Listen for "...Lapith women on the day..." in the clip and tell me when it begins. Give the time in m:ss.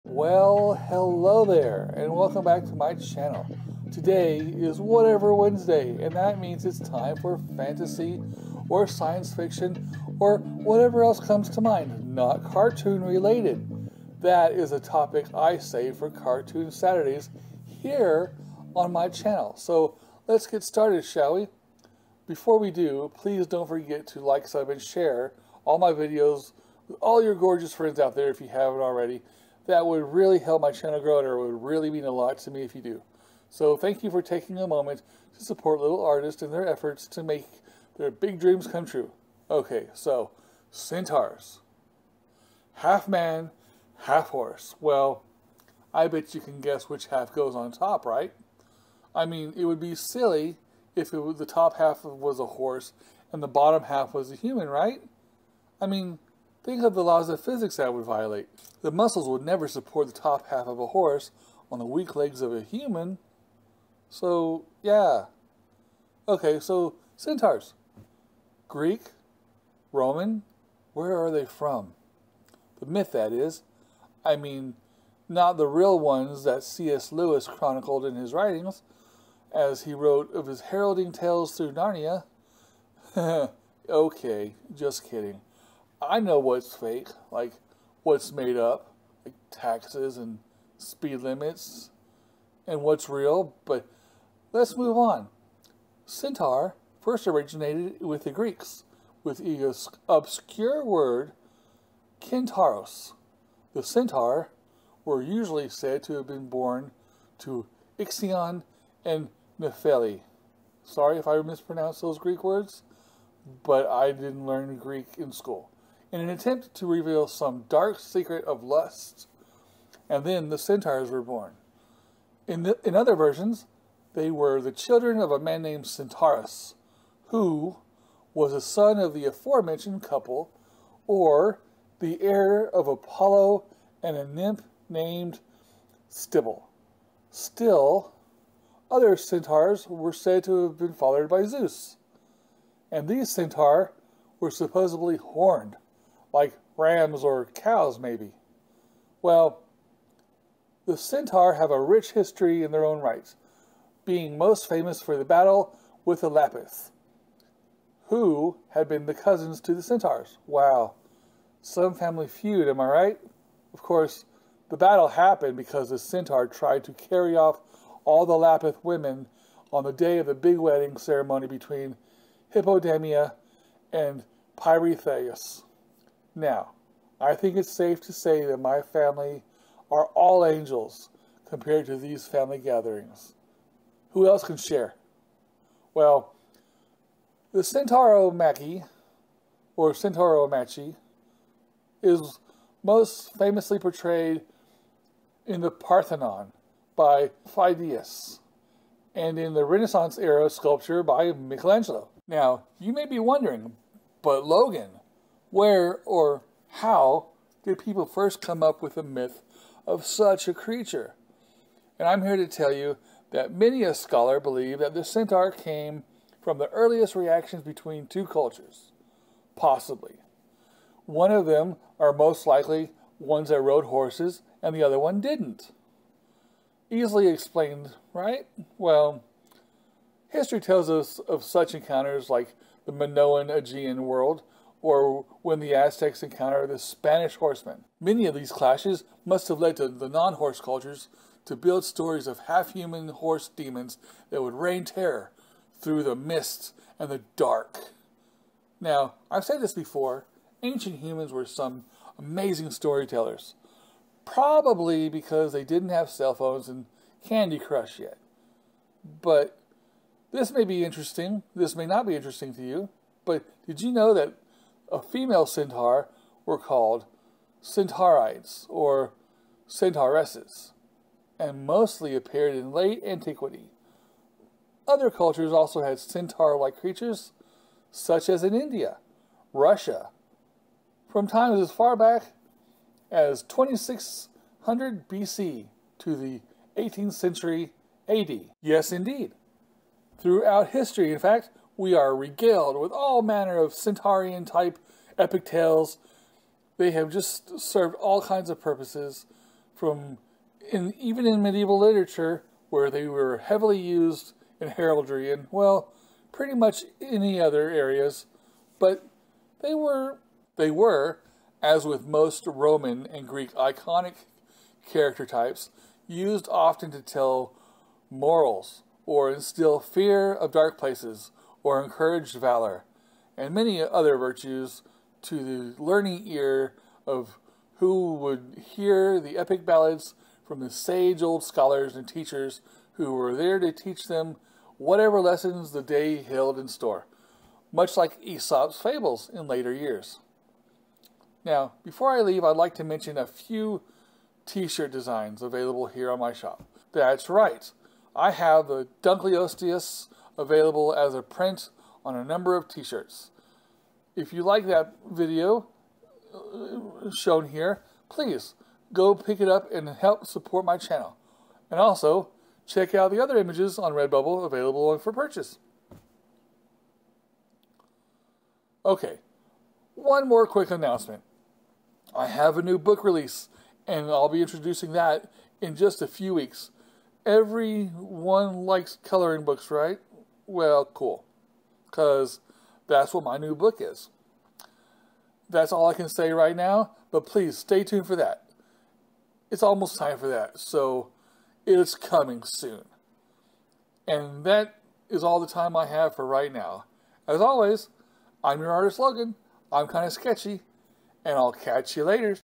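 2:48.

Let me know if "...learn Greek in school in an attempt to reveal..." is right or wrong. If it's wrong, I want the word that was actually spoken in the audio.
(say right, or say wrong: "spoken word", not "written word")
right.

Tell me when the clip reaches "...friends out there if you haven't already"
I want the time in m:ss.
0:27.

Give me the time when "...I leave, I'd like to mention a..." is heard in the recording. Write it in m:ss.
5:42.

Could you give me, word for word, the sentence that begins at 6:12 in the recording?
I have a new book release, and I'll be introducing that in just a few weeks.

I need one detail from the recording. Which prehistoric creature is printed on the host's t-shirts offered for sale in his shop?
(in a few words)
Dunkleosteus.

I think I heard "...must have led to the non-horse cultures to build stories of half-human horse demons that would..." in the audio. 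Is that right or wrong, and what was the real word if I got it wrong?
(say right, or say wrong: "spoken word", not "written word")
right.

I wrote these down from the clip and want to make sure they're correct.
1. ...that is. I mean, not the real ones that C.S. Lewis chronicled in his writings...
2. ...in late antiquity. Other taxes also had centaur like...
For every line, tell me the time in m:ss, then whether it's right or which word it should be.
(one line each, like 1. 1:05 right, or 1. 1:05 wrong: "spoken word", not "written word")
1. 1:13 right
2. 4:32 wrong: "cultures", not "taxes".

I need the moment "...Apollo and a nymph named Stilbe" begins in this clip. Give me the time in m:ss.
2:12.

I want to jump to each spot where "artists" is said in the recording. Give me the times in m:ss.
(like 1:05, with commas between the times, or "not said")
0:36, 6:38.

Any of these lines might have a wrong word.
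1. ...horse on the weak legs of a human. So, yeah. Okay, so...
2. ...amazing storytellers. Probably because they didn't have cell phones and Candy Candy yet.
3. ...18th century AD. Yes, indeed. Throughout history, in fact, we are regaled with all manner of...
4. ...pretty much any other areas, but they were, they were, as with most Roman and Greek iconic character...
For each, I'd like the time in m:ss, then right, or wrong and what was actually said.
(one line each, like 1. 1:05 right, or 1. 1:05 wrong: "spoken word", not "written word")
1. 1:00 right
2. 4:12 wrong: "Crush", not "Candy"
3. 4:46 right
4. 5:06 right.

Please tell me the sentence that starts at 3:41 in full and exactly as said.
One of them are most likely ones that rode horses and the other one didn't.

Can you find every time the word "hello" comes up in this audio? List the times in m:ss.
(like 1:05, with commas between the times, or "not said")
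0:00.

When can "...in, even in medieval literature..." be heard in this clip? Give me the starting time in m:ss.
5:00.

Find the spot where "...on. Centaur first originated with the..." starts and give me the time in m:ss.
1:34.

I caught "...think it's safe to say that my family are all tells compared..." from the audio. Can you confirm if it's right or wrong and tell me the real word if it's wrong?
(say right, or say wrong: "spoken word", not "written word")
wrong: "angels", not "tells".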